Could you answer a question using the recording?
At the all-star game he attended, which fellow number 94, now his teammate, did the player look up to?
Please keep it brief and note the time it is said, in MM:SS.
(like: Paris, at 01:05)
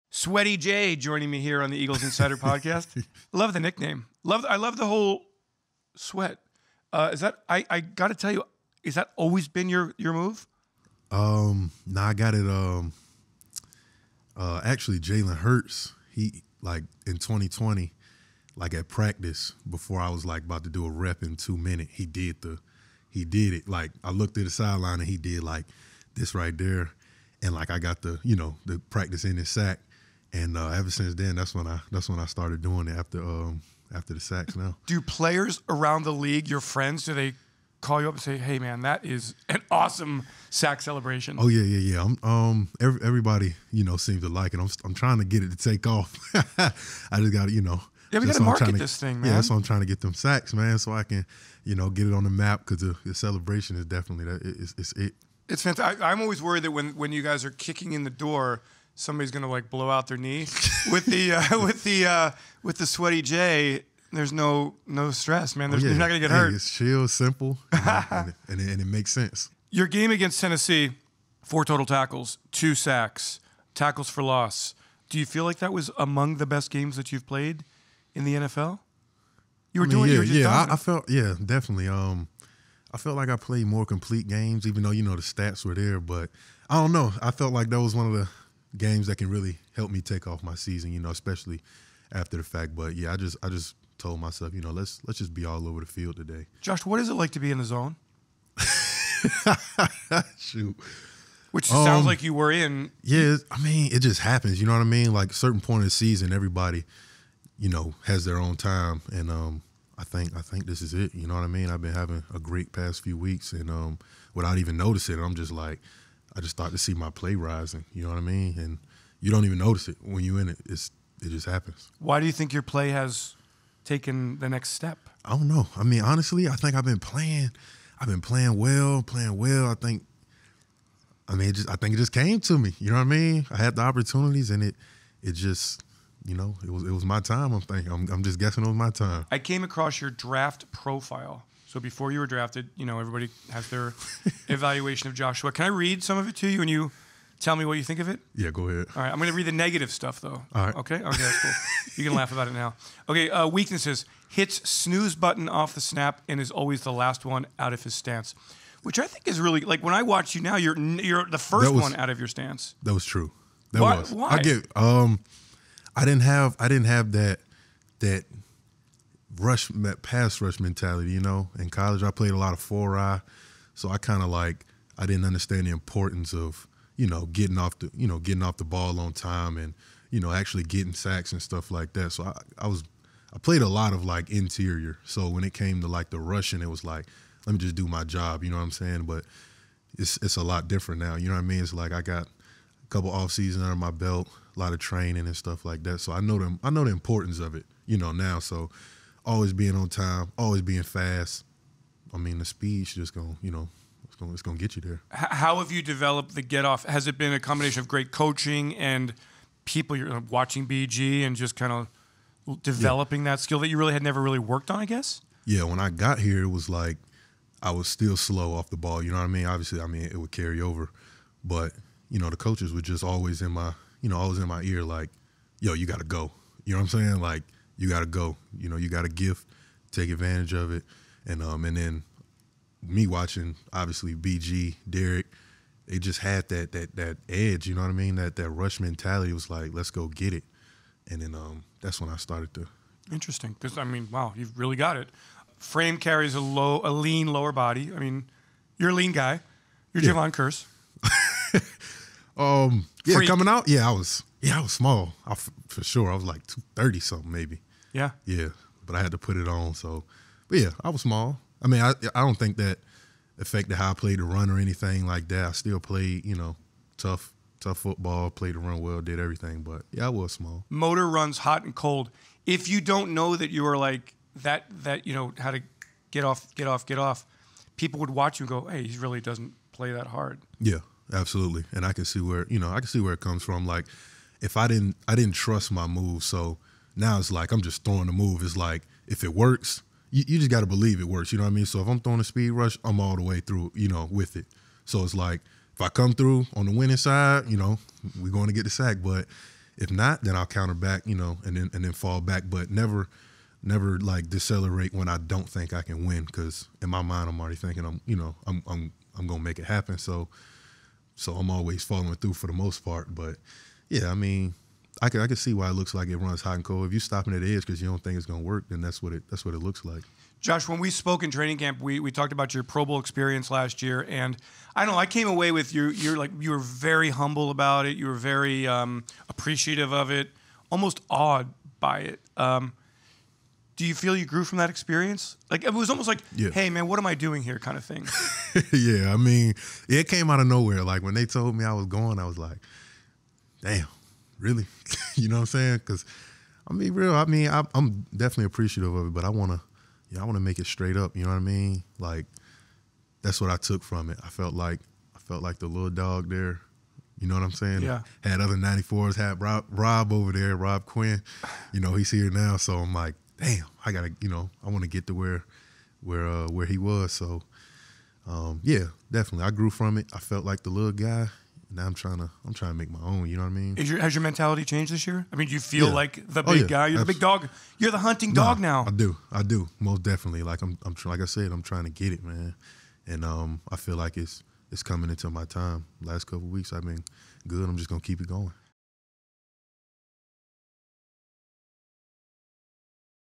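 Rob Quinn, at 06:00.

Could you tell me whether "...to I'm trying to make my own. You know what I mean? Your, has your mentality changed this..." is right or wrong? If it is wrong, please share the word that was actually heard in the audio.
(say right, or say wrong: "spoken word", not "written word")
right.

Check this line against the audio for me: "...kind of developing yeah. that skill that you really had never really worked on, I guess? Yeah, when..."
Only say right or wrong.
right.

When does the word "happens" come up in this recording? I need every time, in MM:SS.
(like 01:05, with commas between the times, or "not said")
01:44, 02:01, 05:09.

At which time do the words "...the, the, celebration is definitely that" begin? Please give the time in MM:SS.
00:52.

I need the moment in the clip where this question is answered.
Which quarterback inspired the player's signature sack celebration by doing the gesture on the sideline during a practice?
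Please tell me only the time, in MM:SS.
00:14.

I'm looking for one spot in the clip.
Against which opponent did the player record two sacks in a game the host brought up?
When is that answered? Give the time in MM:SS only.
01:10.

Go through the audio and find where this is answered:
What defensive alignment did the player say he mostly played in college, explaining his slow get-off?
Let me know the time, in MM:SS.
02:52.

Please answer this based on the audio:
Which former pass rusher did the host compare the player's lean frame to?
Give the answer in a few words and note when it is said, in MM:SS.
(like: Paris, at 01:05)
Jevon Kearse, at 04:10.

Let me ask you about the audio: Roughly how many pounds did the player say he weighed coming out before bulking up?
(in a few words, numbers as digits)
230 something.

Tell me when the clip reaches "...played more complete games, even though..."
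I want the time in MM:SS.
01:23.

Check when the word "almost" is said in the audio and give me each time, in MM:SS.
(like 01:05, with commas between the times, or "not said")
05:30, 05:35.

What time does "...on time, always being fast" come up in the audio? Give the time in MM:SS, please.
03:19.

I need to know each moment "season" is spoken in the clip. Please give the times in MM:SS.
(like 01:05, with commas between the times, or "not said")
01:30, 01:45, 03:13.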